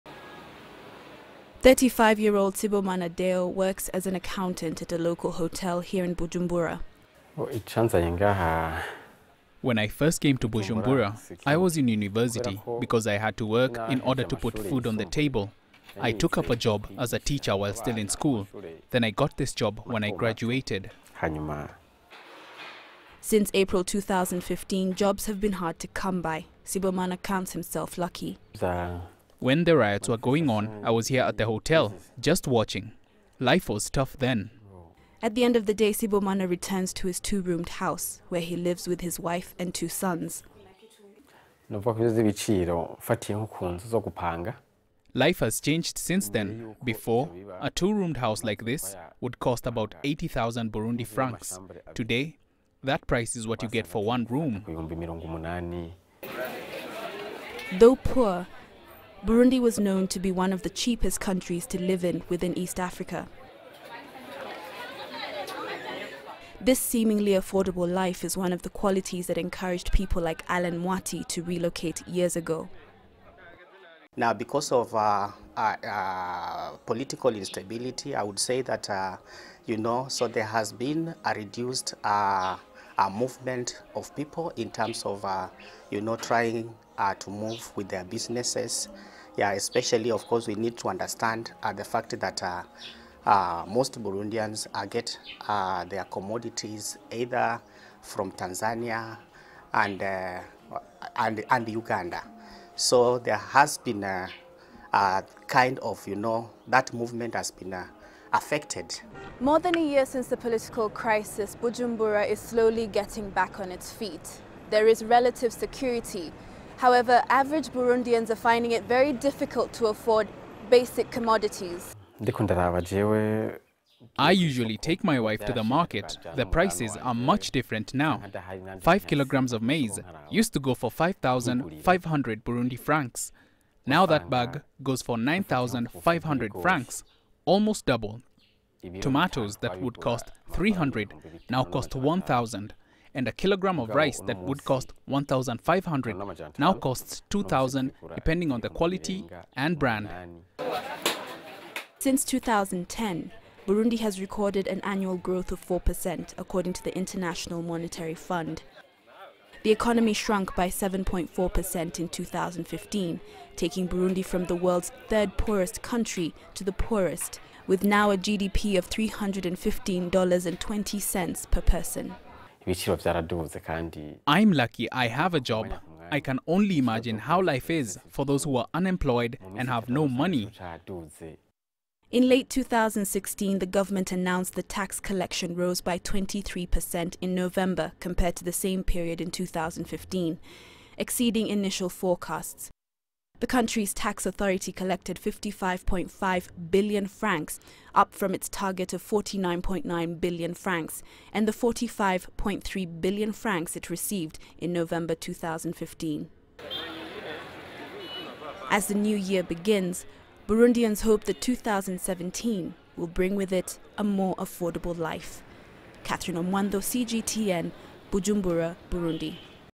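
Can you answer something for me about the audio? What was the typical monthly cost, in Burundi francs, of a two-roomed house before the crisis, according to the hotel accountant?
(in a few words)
80,000.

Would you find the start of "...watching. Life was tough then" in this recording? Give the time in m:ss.
0:32.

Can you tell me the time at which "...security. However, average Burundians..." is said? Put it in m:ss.
1:55.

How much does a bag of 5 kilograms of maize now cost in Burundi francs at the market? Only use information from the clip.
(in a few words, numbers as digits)
9,500 francs.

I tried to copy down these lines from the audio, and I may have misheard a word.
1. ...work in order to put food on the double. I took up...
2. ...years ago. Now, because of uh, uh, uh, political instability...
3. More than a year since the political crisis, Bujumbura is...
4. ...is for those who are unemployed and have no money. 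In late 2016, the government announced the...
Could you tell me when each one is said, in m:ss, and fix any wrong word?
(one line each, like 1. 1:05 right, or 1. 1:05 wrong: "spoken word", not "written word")
1. 0:13 wrong: "table", not "double"
2. 1:12 right
3. 1:49 right
4. 2:57 right.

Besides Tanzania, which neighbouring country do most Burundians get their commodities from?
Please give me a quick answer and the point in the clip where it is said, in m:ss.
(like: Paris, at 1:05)
Uganda, at 1:41.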